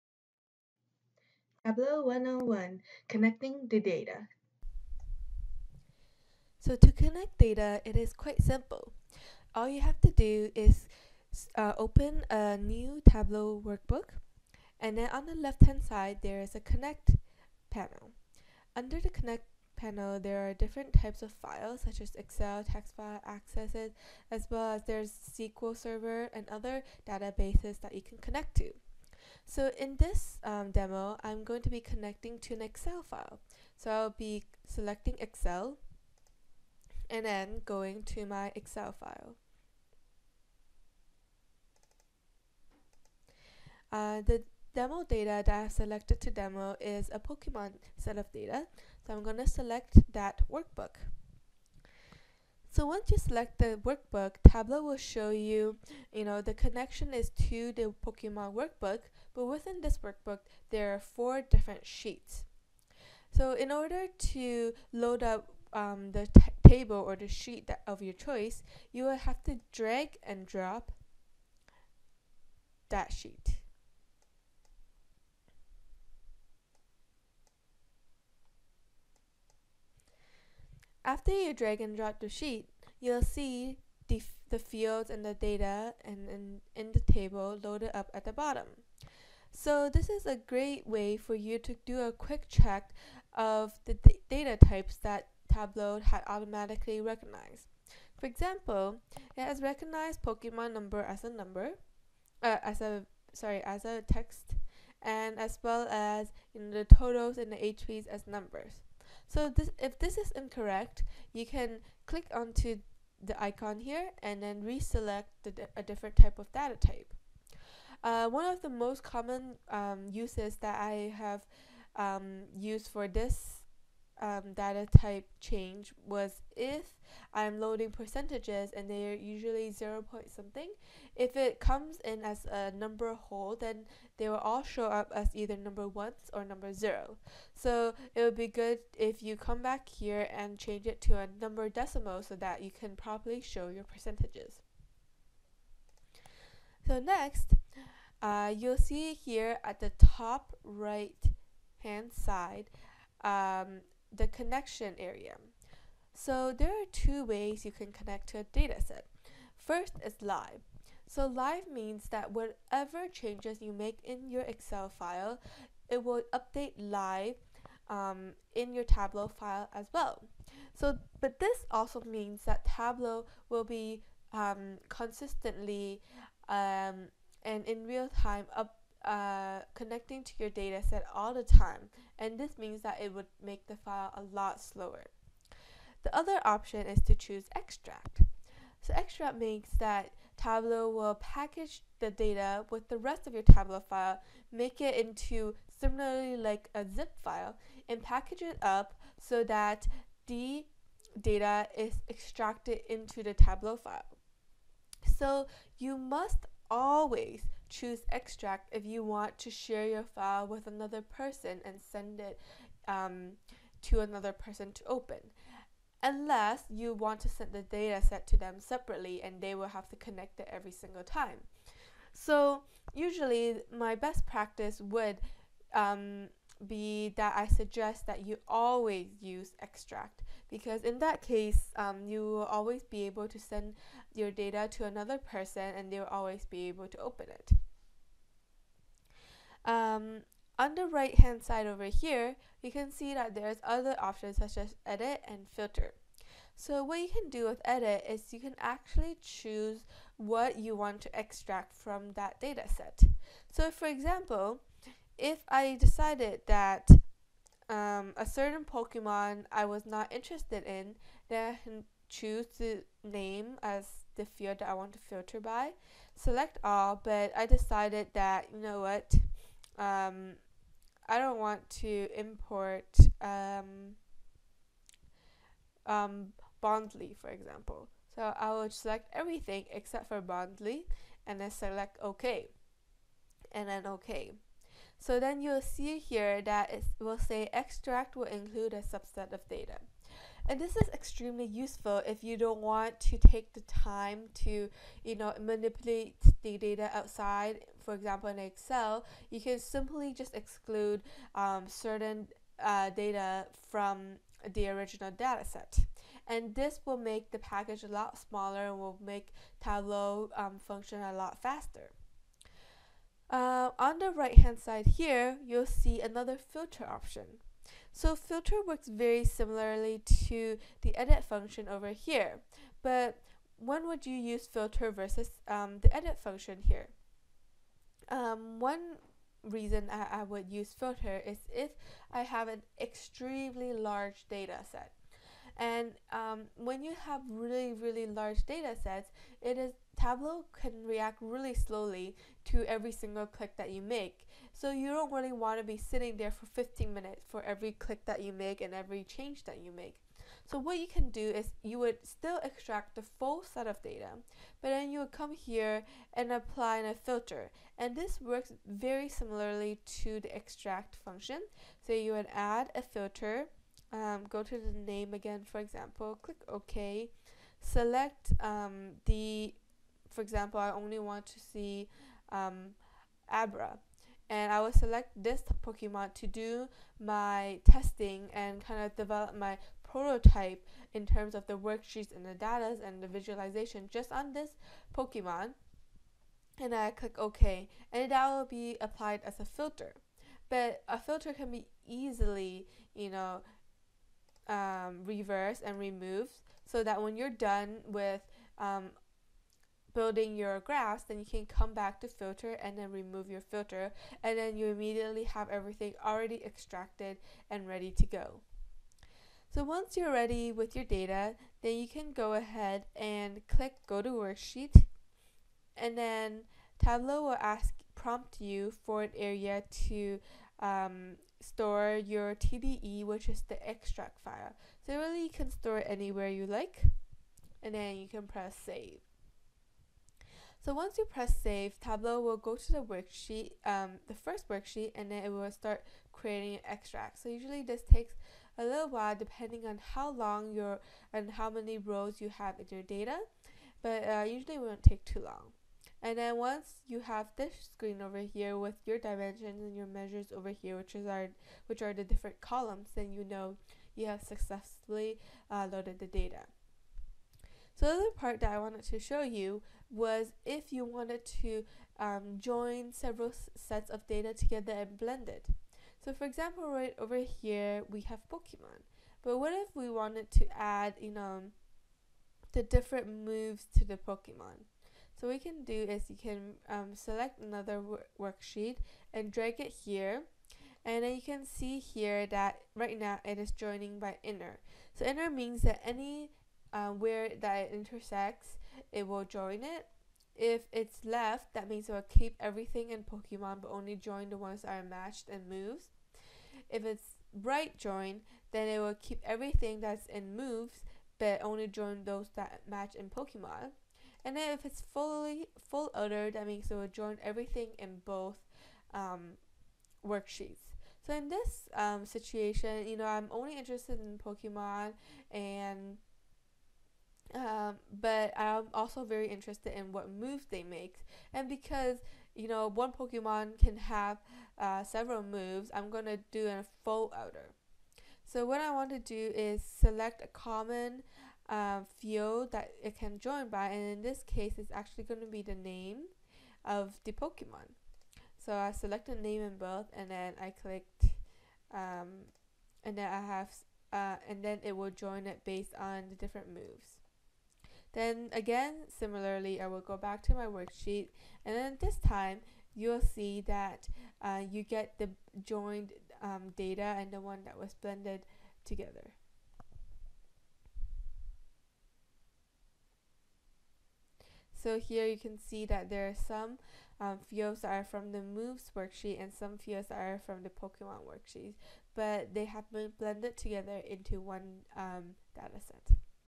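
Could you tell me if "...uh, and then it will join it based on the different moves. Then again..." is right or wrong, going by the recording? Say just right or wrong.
right.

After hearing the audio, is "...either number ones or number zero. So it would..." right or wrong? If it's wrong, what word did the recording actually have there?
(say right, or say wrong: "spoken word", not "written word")
right.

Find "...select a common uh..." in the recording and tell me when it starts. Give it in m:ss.
8:49.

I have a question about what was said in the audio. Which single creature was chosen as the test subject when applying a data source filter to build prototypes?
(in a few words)
Abra.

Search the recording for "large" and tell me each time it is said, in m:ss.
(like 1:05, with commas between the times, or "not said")
5:33, 5:38.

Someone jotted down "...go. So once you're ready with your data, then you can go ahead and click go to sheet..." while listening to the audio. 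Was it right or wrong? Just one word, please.
wrong.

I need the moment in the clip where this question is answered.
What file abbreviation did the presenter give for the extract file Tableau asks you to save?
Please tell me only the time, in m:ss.
7:02.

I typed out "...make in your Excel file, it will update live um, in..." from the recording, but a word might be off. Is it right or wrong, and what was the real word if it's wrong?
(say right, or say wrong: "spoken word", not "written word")
right.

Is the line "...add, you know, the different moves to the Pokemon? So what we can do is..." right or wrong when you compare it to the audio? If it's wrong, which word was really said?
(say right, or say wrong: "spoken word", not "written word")
right.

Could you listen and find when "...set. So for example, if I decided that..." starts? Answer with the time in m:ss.
4:12.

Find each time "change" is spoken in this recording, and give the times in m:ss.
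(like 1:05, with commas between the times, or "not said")
2:05, 2:20, 2:43, 5:49.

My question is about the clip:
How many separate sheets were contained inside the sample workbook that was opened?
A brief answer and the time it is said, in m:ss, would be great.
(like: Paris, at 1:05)
4, at 1:01.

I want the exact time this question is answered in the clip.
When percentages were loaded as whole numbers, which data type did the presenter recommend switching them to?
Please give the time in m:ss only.
2:21.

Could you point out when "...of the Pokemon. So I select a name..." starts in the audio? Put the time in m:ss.
8:56.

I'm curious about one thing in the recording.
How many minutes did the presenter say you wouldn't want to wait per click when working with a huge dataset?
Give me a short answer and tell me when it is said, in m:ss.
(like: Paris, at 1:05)
15, at 5:46.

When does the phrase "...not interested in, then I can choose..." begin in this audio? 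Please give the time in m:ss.
4:19.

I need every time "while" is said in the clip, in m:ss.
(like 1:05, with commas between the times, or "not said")
7:18.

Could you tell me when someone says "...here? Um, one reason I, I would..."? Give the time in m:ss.
5:26.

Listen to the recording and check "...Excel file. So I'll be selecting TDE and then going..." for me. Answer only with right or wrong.
wrong.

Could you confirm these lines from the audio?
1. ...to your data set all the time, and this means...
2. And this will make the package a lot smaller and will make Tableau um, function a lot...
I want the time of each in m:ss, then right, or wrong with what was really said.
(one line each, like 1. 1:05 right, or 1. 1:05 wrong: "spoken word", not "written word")
1. 3:00 right
2. 5:06 right.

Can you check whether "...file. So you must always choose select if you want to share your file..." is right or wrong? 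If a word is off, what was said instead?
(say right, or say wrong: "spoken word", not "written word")
wrong: "extract", not "select".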